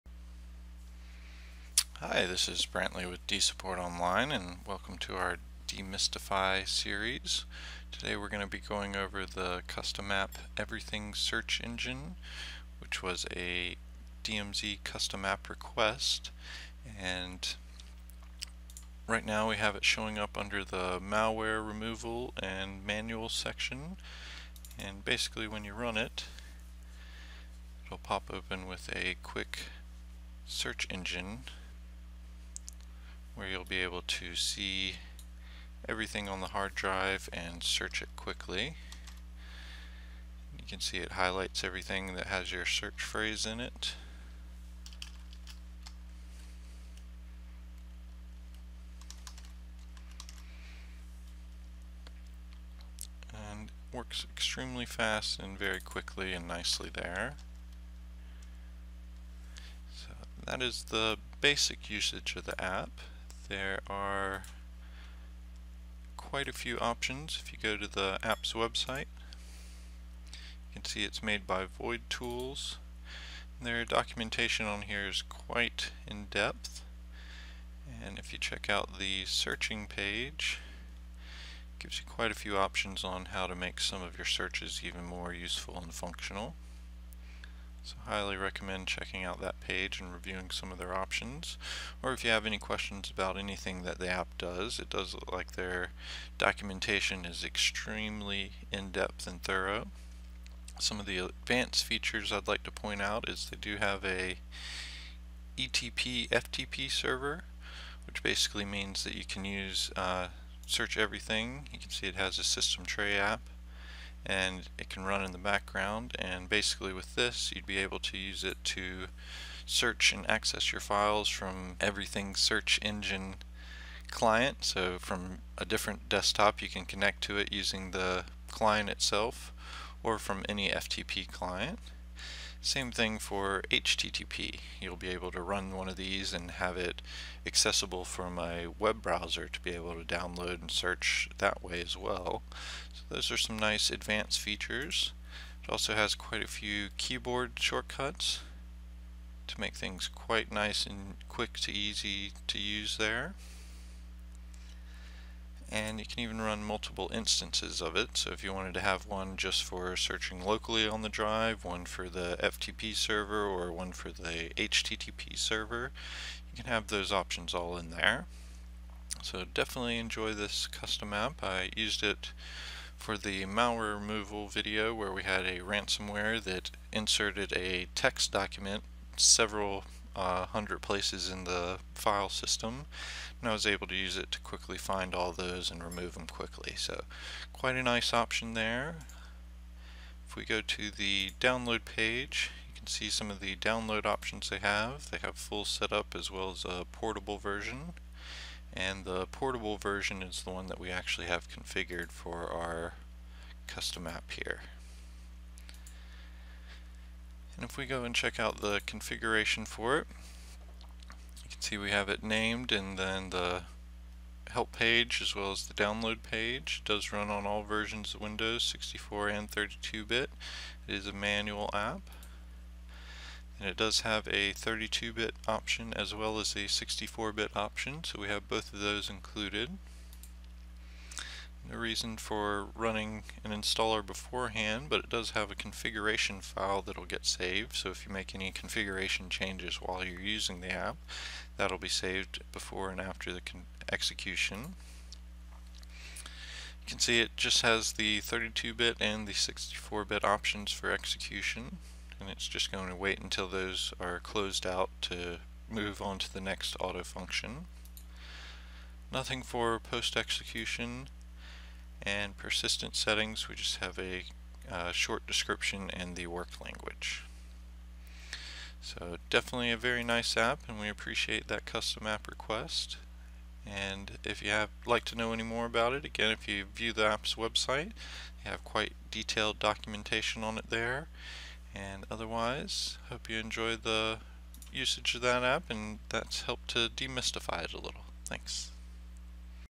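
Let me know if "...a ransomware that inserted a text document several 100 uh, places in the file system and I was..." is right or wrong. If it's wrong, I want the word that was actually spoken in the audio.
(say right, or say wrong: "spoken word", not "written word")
right.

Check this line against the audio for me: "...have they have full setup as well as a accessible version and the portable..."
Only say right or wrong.
wrong.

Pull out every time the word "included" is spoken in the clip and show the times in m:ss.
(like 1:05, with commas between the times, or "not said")
3:49.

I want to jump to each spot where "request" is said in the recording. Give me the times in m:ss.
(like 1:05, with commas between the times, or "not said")
0:15, 4:32.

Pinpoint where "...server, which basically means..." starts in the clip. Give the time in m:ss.
1:46.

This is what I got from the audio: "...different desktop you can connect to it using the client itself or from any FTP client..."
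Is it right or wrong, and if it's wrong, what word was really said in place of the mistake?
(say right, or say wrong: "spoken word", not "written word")
right.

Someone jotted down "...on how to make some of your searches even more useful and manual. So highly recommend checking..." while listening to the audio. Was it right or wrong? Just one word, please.
wrong.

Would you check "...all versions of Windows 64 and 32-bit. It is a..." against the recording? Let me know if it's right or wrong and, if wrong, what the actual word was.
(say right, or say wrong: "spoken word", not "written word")
right.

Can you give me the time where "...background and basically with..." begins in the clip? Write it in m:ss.
1:55.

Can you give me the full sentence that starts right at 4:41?
And otherwise, hope you enjoy the usage of that app and that's helped to demystify it a little.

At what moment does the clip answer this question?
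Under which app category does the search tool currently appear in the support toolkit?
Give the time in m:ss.
0:20.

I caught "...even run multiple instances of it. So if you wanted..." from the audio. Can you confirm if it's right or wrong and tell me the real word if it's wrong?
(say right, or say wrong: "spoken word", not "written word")
right.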